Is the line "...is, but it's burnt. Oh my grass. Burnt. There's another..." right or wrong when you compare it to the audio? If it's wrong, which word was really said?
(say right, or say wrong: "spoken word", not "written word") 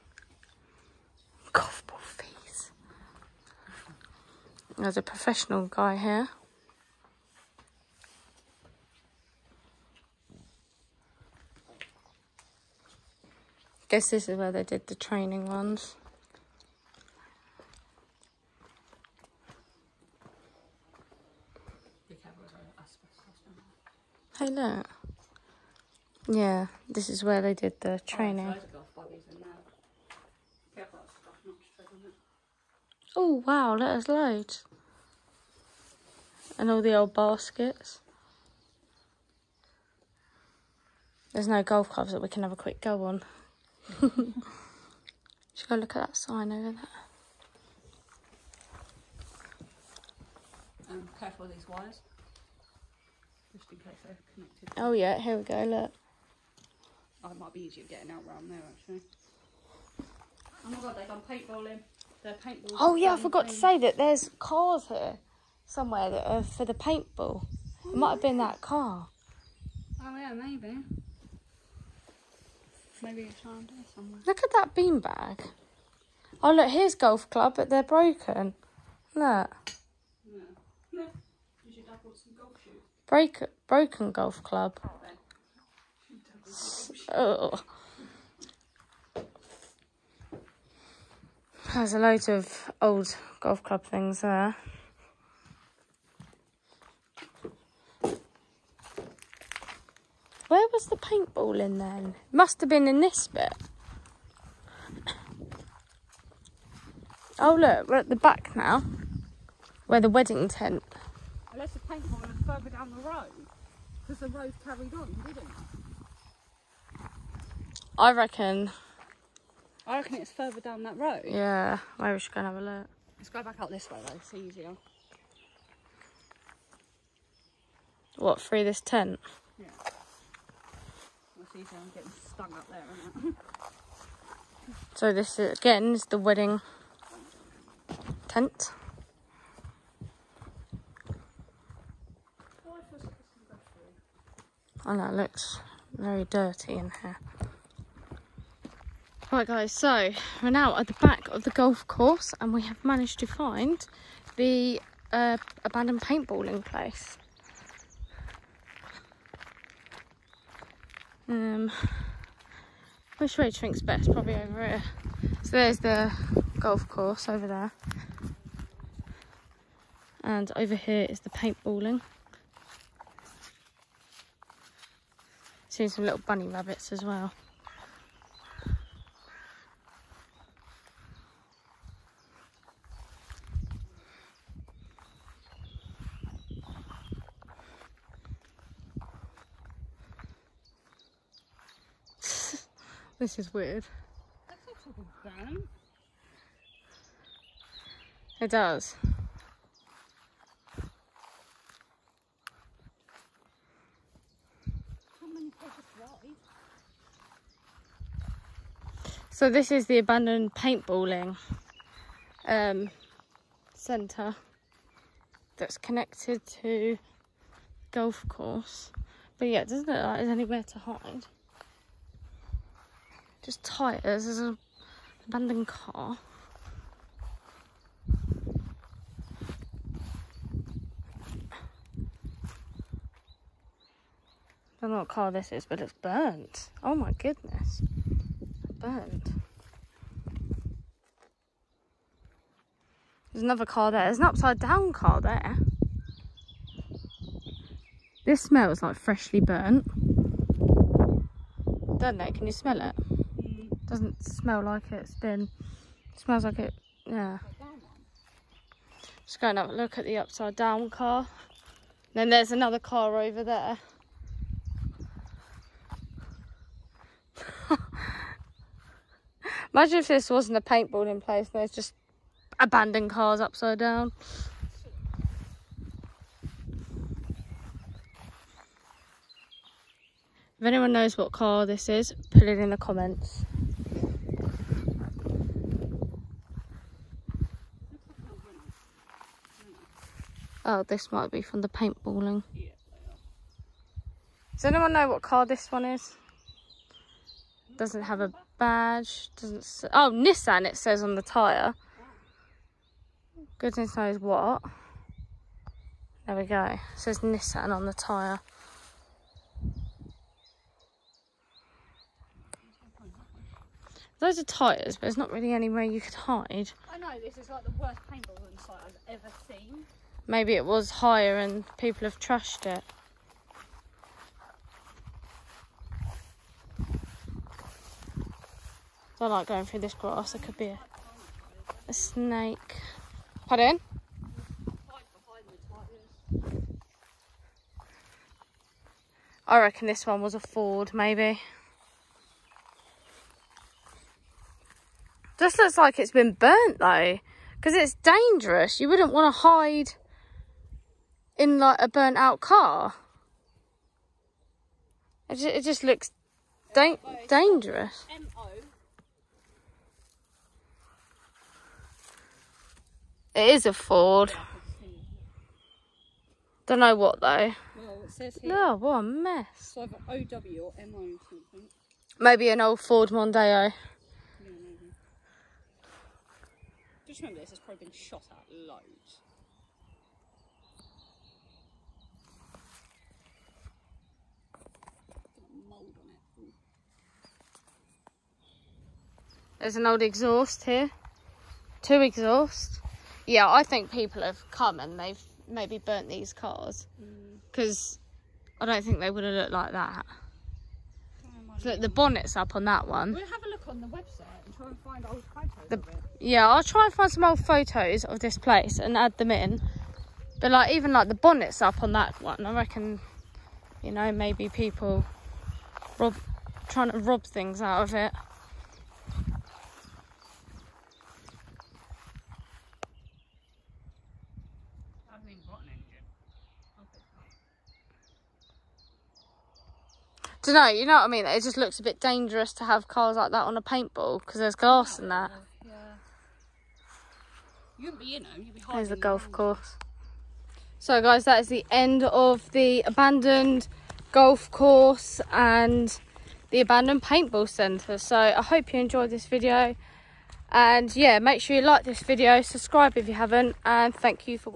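wrong: "goodness", not "grass".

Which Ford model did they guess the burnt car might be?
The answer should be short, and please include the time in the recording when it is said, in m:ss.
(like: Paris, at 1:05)
Ford Mondeo, at 6:12.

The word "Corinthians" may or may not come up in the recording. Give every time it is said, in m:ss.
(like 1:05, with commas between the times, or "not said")
not said.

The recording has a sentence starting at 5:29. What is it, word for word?
I like going through this grass, It could be a, a snake.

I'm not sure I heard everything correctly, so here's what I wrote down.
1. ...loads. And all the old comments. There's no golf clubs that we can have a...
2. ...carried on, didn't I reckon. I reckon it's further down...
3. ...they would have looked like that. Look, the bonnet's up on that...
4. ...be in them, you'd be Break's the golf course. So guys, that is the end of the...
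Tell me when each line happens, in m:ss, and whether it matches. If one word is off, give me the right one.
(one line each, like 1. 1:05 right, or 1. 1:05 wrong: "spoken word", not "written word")
1. 0:34 wrong: "baskets", not "comments"
2. 1:54 right
3. 6:38 right
4. 7:17 wrong: "There", not "Break".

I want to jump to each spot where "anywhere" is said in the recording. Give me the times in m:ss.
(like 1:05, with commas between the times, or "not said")
3:40, 5:15.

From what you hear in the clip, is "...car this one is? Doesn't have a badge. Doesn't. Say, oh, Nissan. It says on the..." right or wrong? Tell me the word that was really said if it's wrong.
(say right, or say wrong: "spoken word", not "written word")
right.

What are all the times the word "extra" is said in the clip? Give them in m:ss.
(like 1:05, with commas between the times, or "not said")
not said.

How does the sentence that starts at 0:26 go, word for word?
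Yeah, this is where they did the oh, training.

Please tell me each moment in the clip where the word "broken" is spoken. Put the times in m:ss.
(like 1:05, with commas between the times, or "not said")
1:17, 1:23.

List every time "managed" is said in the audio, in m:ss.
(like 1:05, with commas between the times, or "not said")
2:32.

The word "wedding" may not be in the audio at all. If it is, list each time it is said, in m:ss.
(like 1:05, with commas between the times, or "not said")
1:50, 2:16.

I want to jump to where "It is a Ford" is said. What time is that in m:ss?
6:03.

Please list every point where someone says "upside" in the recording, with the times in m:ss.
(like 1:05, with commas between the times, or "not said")
4:04, 4:20, 4:33.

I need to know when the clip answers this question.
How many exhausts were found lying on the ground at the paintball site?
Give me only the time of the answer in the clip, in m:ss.
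6:31.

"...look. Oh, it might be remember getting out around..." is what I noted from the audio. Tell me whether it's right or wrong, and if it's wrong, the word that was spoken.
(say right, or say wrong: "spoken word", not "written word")
wrong: "easier", not "remember".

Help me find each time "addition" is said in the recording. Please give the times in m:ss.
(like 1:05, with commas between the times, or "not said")
not said.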